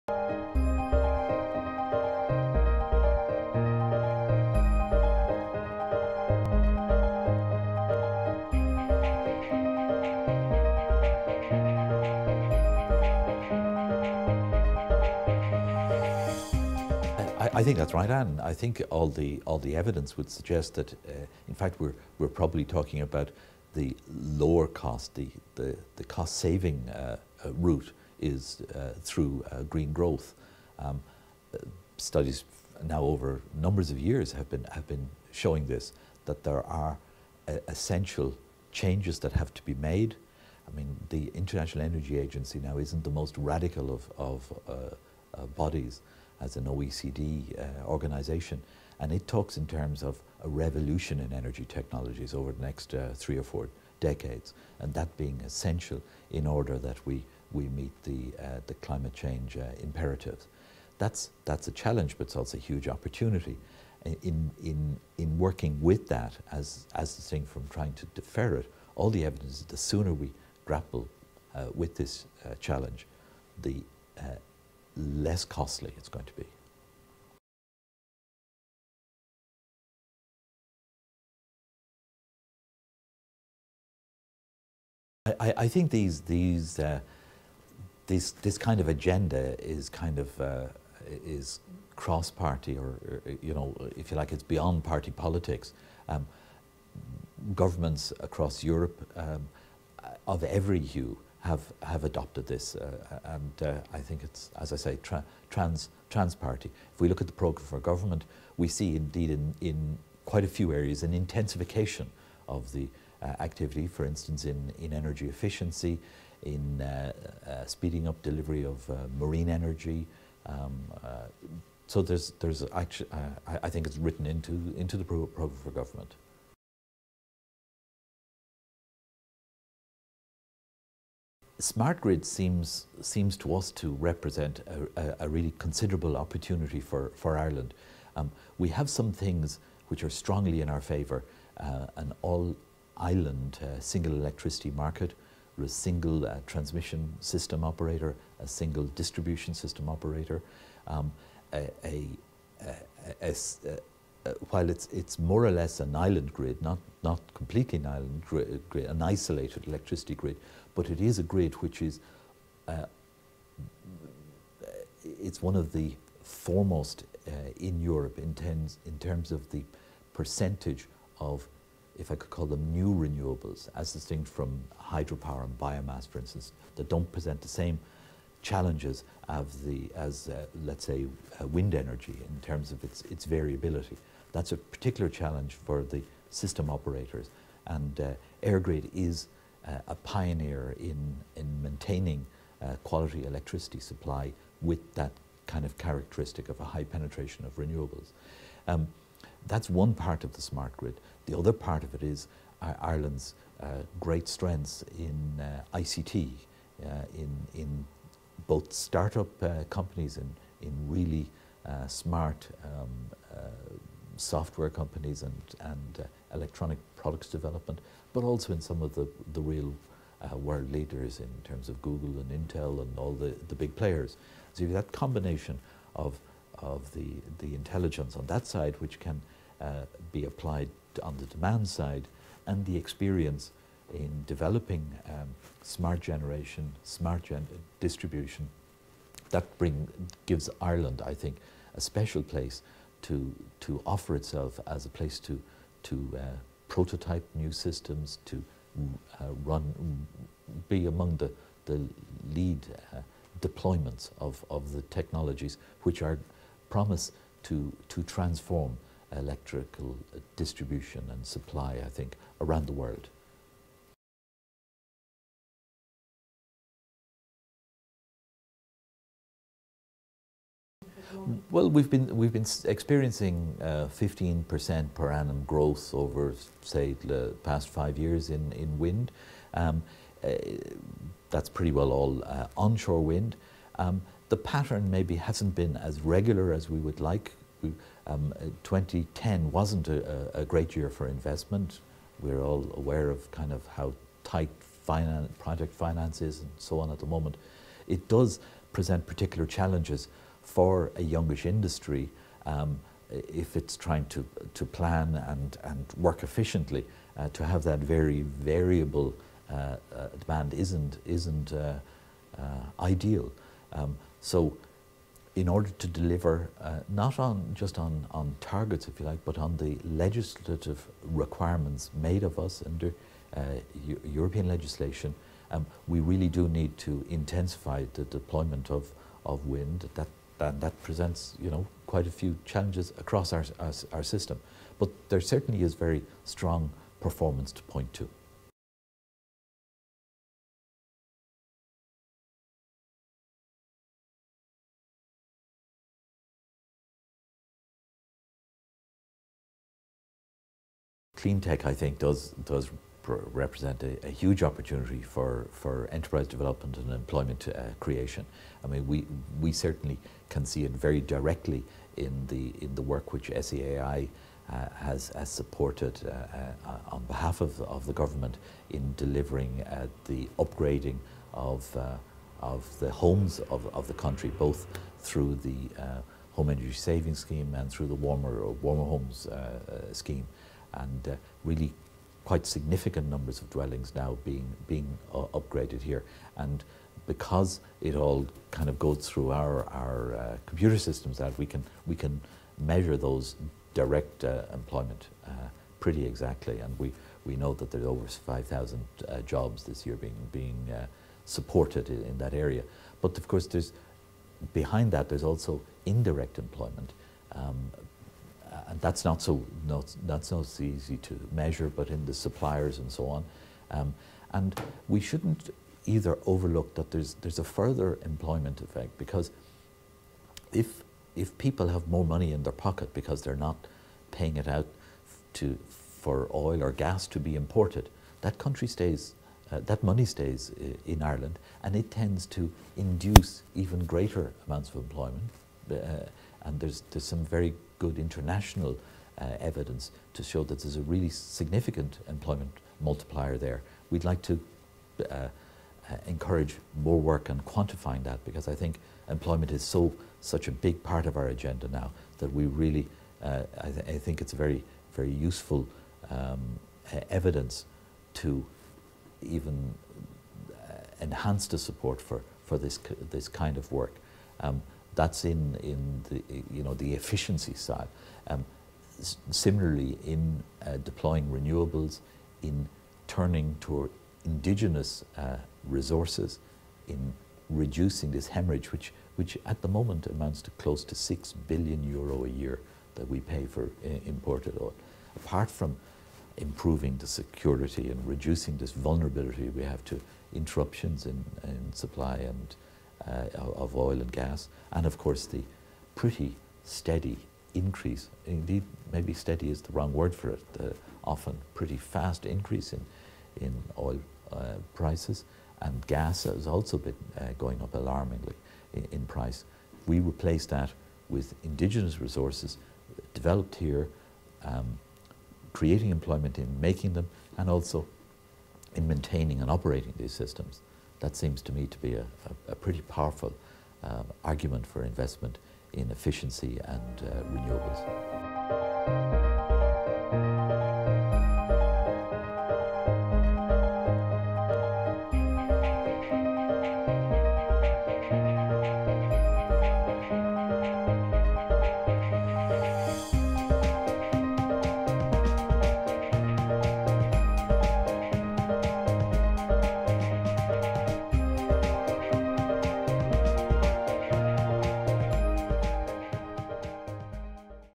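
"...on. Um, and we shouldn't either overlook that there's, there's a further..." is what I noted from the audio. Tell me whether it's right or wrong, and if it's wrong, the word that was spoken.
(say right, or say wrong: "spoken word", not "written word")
right.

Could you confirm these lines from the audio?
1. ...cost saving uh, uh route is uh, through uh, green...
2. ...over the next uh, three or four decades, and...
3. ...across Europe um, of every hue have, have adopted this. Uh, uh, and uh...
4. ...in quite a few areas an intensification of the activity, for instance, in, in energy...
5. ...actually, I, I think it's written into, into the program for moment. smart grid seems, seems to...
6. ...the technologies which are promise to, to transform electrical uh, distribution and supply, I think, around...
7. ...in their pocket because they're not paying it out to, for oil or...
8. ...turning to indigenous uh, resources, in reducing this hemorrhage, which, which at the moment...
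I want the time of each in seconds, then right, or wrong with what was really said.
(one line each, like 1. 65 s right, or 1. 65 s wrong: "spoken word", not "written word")
1. 26 s right
2. 52 s right
3. 98 s right
4. 109 s right
5. 122 s wrong: "government", not "moment"
6. 254 s right
7. 422 s right
8. 473 s right.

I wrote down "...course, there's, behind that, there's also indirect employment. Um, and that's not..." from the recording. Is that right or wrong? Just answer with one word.
right.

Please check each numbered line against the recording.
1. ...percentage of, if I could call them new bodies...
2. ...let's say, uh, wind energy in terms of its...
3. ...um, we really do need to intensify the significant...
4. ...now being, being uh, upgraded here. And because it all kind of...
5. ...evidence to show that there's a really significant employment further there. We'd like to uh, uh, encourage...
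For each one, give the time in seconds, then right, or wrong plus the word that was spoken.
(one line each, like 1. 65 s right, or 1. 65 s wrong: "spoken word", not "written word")
1. 170 s wrong: "renewables", not "bodies"
2. 180 s right
3. 325 s wrong: "deployment", not "significant"
4. 383 s right
5. 439 s wrong: "multiplier", not "further".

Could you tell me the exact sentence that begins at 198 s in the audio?
Um, that's one part of the smart grid.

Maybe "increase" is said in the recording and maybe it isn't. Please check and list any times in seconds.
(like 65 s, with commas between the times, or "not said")
497 s, 502 s.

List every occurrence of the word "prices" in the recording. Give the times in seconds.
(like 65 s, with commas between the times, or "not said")
504 s, 509 s.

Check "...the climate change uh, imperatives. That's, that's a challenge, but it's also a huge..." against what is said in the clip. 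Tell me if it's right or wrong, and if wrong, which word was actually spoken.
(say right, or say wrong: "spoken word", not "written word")
right.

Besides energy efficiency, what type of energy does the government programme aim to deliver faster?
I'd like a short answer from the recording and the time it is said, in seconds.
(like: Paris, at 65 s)
marine energy, at 119 s.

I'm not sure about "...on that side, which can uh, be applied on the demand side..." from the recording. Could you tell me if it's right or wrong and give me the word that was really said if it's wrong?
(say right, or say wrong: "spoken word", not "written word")
right.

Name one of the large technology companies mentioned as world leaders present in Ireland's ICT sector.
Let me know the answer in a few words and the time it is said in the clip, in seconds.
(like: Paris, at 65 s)
Google, at 221 s.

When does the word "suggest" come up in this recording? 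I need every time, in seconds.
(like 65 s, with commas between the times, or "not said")
20 s.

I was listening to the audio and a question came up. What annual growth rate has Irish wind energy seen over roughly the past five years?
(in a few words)
15%.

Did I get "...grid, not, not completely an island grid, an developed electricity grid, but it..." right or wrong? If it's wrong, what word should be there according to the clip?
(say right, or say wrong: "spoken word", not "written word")
wrong: "isolated", not "developed".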